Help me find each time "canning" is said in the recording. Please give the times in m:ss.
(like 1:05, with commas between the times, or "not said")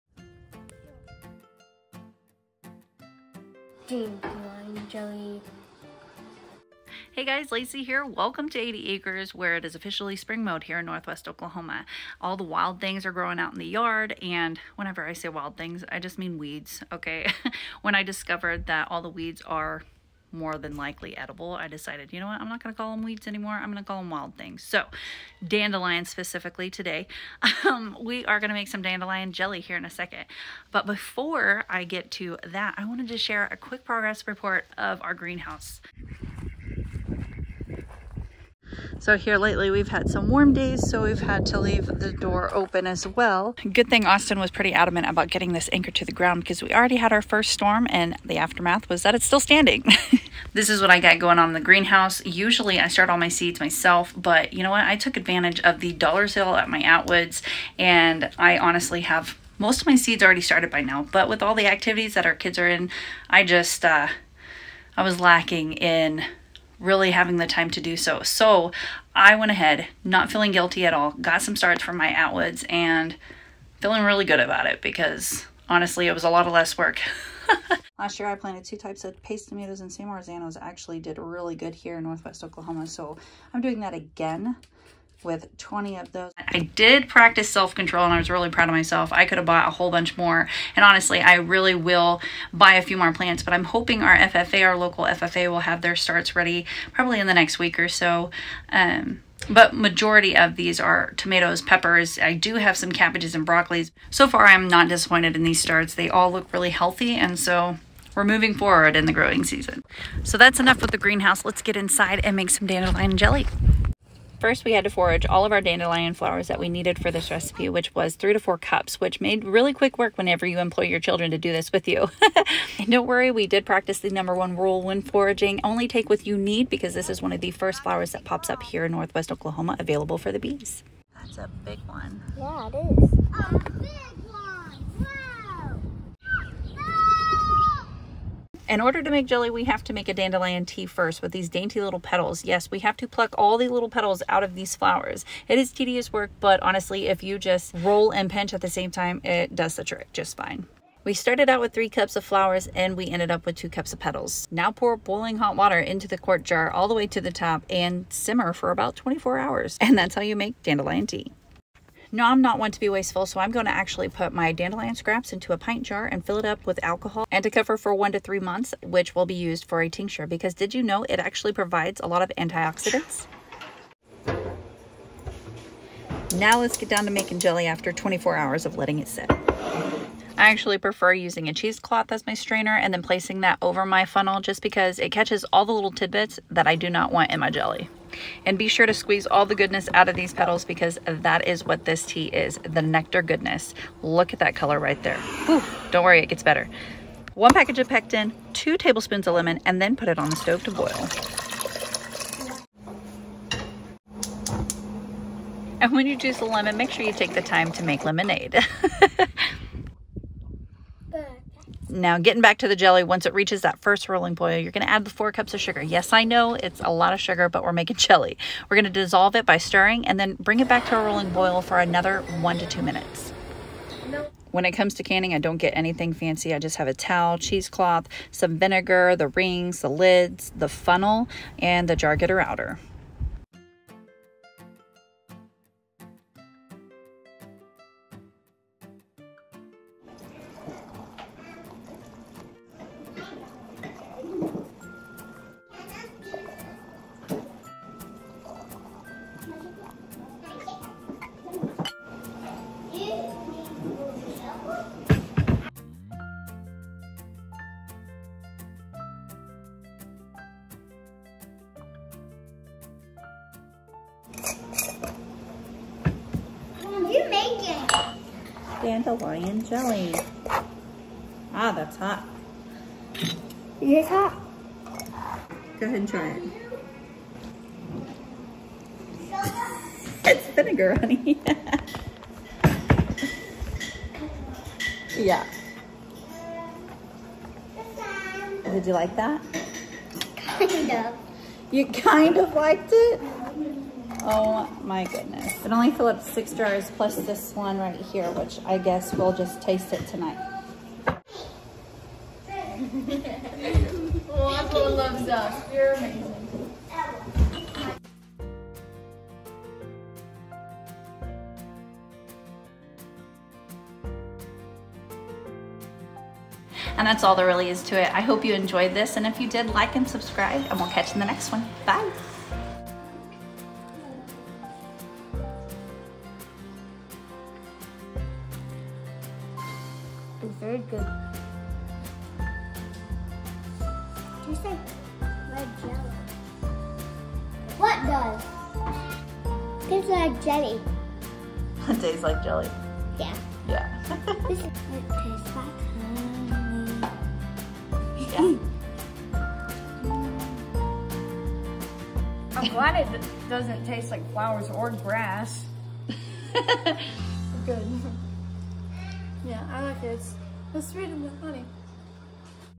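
3:45.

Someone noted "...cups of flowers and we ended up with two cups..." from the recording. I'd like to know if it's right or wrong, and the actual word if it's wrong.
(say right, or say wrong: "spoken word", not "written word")
right.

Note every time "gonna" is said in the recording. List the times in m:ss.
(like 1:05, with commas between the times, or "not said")
3:34, 3:38.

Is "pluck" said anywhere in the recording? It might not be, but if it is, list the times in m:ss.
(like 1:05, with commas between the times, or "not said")
2:23.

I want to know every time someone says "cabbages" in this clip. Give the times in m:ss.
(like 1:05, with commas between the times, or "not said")
1:42.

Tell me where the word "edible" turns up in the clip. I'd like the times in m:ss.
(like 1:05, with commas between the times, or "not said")
0:21.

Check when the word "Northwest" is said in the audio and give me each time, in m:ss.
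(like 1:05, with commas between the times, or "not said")
0:10, 1:22, 2:08.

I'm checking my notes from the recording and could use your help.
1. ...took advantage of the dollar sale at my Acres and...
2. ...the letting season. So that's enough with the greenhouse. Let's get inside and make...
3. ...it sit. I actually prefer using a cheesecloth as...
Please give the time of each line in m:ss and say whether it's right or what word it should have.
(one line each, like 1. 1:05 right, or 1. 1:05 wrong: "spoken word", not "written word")
1. 0:54 wrong: "Atwoods", not "Acres"
2. 1:49 wrong: "growing", not "letting"
3. 2:58 right.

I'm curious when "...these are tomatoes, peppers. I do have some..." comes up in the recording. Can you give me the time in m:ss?
1:40.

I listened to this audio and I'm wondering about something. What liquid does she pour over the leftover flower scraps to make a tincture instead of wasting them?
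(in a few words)
Alcohol.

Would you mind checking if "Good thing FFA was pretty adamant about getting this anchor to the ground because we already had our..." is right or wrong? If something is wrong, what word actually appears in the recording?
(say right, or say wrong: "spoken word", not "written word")
wrong: "Austin", not "FFA".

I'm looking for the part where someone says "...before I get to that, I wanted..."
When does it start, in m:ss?
0:30.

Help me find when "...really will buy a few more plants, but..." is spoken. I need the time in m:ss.
1:31.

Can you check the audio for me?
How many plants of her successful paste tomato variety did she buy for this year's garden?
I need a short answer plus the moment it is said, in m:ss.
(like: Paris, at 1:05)
20, at 1:25.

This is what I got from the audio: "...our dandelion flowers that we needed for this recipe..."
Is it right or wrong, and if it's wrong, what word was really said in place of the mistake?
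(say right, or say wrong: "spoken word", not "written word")
right.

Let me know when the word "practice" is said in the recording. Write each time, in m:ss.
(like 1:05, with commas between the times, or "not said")
1:27, 2:03.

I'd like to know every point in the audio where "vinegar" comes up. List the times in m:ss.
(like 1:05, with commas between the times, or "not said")
3:48, 4:40.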